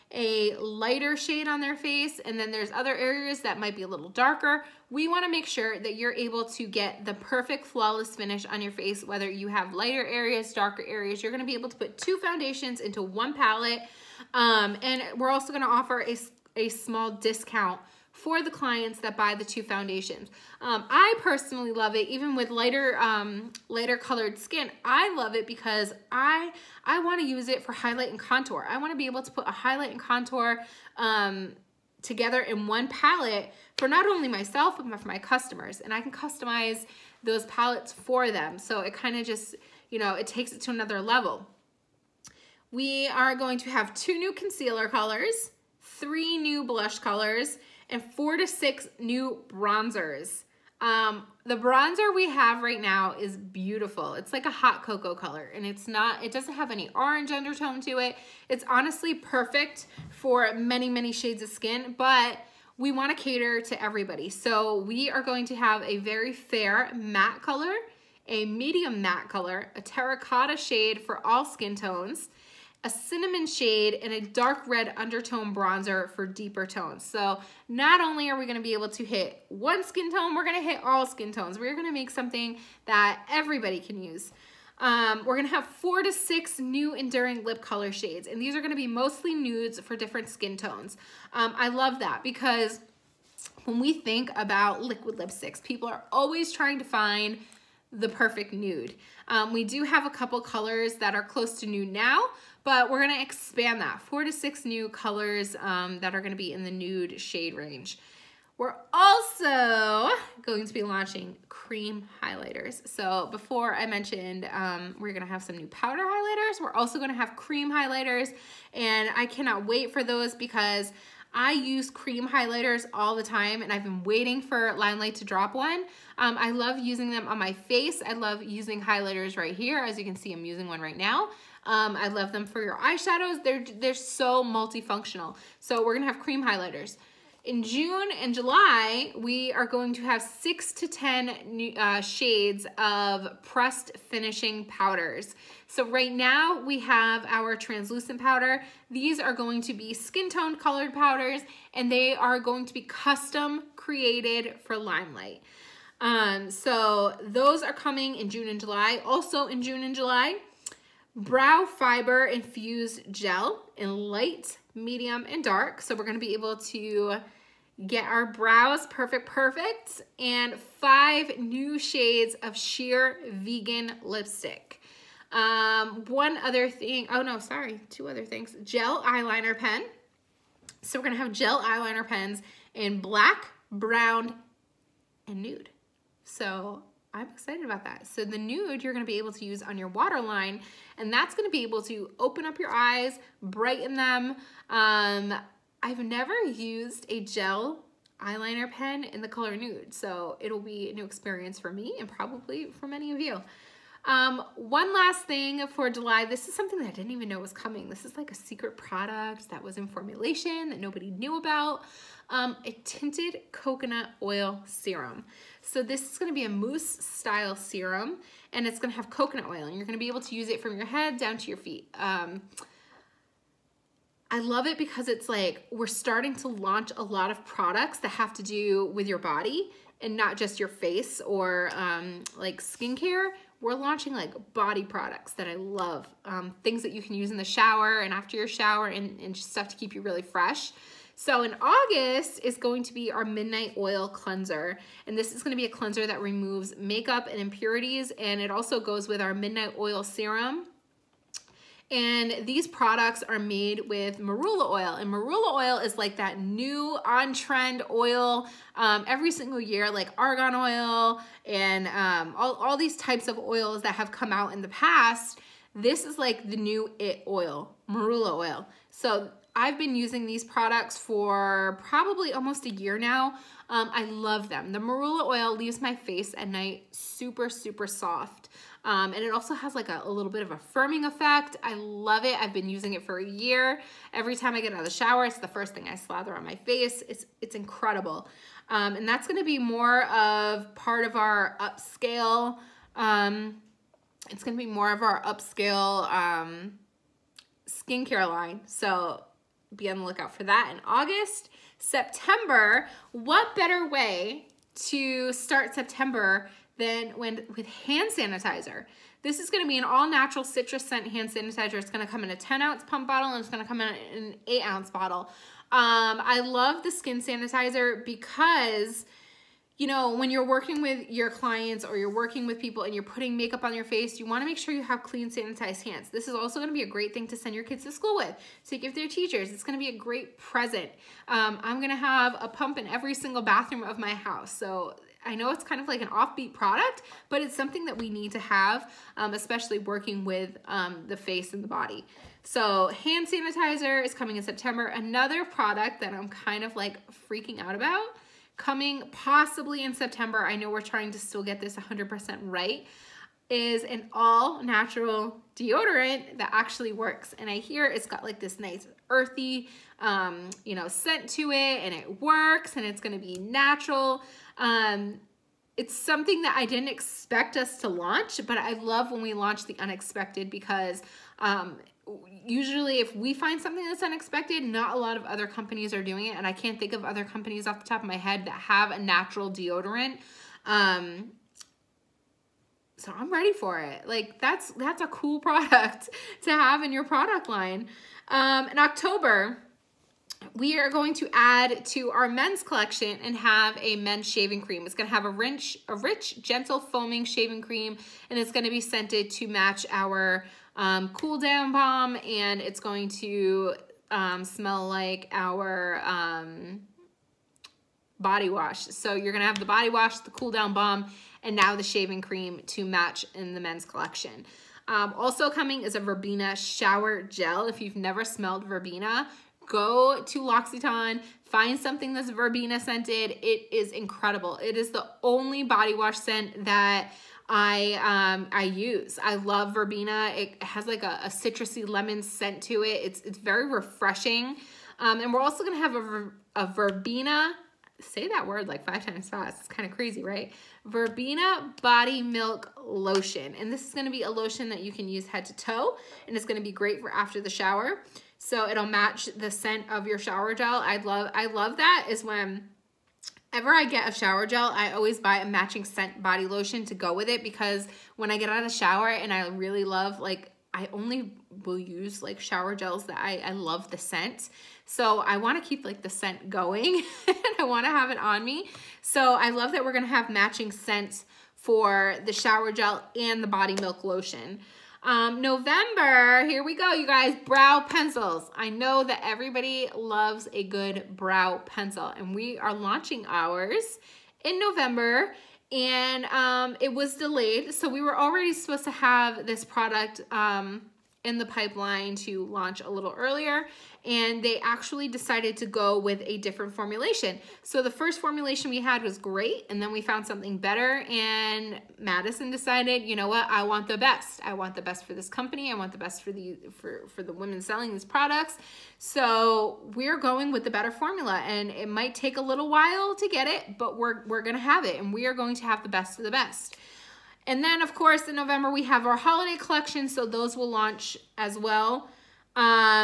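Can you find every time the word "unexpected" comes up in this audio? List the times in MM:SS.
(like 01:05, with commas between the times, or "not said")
06:09, 06:14.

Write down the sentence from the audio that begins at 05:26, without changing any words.
This is also going to be a great thing to send your kids to school with, to give their teachers.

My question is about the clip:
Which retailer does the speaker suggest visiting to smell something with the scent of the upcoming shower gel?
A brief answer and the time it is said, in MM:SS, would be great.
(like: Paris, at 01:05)
L'Occitane, at 07:00.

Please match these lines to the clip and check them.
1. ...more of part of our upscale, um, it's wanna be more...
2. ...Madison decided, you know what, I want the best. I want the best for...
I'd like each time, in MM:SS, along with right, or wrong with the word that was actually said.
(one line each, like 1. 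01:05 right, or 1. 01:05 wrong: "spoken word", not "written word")
1. 04:49 wrong: "gonna", not "wanna"
2. 08:21 right.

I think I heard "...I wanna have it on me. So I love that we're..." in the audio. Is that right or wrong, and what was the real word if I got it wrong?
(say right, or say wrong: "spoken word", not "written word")
right.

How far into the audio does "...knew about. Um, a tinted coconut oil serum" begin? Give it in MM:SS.
03:31.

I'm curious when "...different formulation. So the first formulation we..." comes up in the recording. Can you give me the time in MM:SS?
08:16.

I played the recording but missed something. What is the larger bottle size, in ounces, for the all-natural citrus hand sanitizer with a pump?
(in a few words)
10 ounces.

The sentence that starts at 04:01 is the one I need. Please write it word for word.
So in August is going to be our Midnight Oil Cleanser.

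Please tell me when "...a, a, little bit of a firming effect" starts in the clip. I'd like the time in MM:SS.
04:39.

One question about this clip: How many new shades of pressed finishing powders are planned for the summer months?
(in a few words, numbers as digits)
6 to 10.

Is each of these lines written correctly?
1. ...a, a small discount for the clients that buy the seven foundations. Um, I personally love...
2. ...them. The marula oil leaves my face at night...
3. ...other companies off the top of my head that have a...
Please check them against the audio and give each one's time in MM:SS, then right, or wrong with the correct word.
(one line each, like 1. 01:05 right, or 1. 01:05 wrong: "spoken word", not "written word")
1. 00:16 wrong: "two", not "seven"
2. 04:34 right
3. 06:17 right.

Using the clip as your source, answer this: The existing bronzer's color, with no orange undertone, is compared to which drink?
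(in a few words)
Hot cocoa.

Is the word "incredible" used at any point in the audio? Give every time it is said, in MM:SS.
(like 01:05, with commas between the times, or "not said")
04:47, 07:03.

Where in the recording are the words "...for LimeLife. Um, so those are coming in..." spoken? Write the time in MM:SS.
02:34.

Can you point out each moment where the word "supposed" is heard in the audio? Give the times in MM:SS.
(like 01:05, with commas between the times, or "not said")
08:08.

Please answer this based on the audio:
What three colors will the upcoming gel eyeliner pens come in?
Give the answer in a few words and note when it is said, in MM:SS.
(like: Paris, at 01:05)
Black, brown, and nude, at 03:03.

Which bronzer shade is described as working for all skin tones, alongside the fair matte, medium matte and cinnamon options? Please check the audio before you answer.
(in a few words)
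Terracotta.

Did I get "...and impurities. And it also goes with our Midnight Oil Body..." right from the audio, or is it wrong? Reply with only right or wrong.
wrong.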